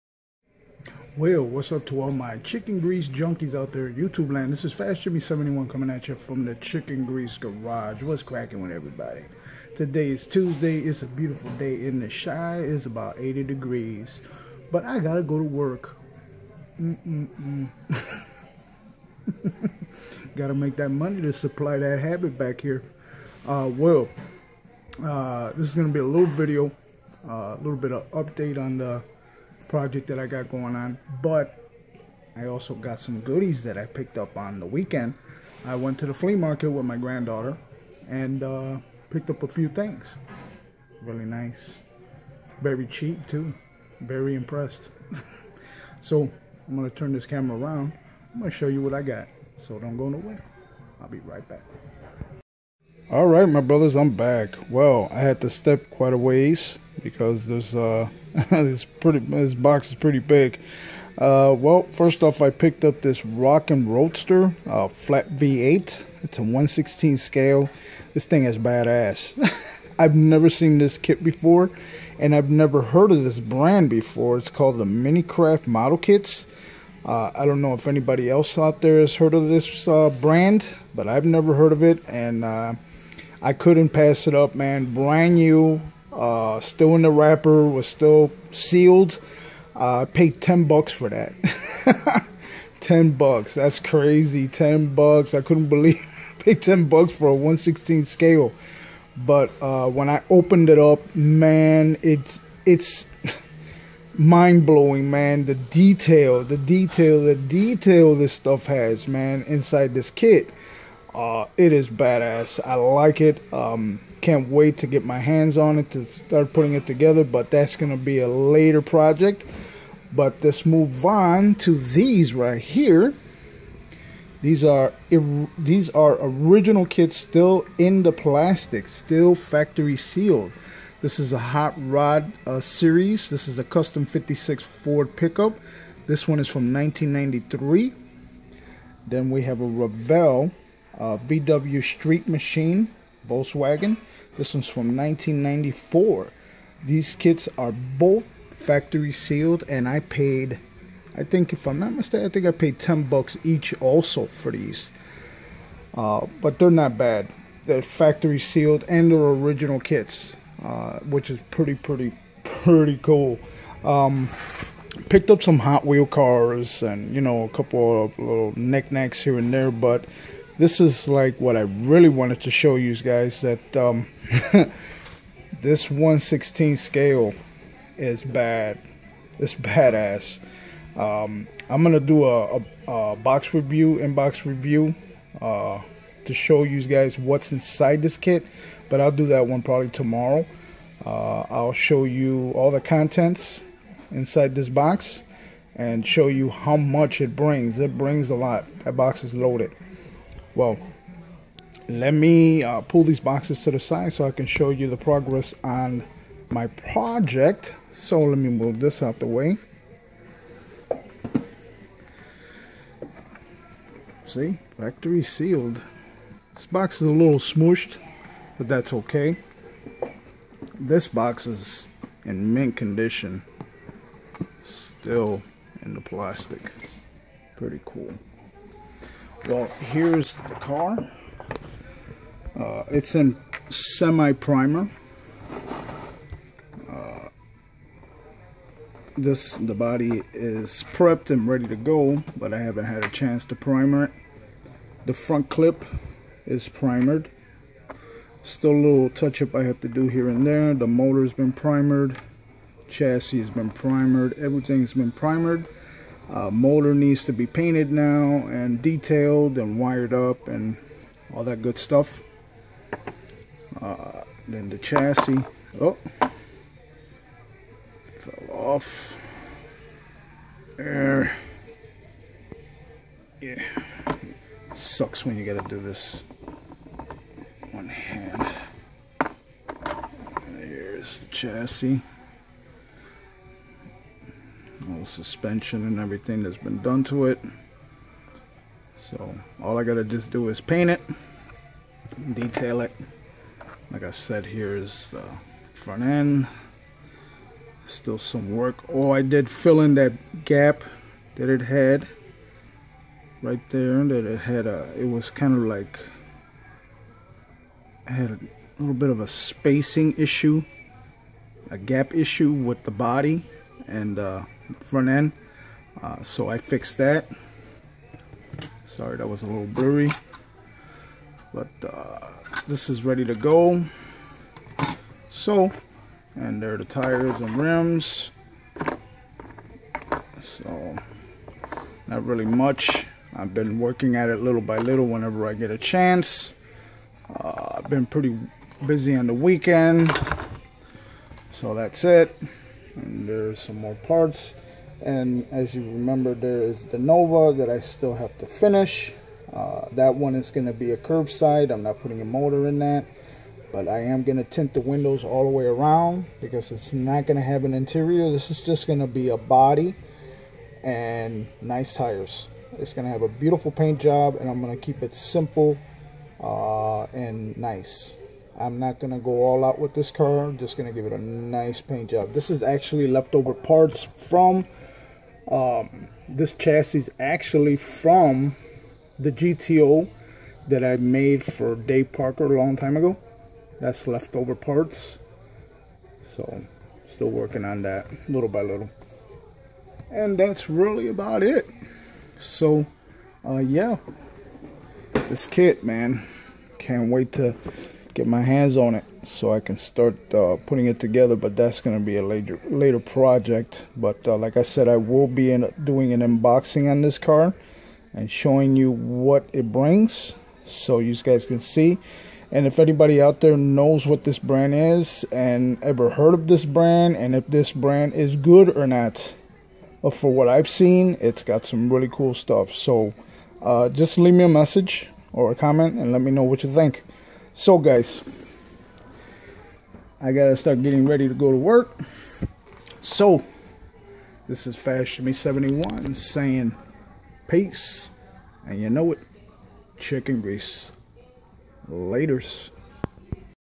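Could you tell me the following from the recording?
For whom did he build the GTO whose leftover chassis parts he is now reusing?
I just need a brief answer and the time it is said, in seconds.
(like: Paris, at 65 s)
Dave Parker, at 381 s.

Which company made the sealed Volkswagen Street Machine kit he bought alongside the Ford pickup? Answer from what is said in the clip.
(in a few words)
Revell.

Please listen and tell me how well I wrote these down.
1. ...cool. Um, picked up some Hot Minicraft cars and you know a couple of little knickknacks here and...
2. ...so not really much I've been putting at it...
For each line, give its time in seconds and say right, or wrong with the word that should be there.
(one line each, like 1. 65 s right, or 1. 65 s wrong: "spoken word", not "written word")
1. 163 s wrong: "Wheel", not "Minicraft"
2. 330 s wrong: "working", not "putting".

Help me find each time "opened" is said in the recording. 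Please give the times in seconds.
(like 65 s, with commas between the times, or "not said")
100 s.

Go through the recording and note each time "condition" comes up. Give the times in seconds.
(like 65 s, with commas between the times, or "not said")
222 s.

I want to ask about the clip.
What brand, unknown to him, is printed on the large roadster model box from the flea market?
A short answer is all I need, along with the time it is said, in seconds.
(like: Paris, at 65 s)
Minicraft Model Kits, at 74 s.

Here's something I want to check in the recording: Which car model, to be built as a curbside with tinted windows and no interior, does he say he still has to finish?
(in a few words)
Nova.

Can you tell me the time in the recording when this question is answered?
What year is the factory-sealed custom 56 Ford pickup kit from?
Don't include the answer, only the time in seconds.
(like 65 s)
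136 s.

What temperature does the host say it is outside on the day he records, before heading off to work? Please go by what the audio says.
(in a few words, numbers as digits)
80 degrees.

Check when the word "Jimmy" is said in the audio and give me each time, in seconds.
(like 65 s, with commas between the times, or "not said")
5 s, 435 s.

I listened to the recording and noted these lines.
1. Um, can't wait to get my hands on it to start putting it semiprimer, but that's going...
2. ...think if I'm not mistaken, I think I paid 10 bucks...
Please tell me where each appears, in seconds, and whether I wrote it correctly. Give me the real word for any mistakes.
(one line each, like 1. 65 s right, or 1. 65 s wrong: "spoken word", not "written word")
1. 113 s wrong: "together", not "semiprimer"
2. 151 s right.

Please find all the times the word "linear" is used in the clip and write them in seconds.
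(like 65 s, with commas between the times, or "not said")
not said.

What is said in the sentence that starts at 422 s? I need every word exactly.
So uh, just leave me a message or a comment and let me know what you think.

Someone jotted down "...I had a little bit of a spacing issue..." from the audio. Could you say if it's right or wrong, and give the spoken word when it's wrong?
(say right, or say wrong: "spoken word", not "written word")
right.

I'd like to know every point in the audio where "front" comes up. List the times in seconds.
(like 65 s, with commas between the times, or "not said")
245 s, 295 s, 314 s.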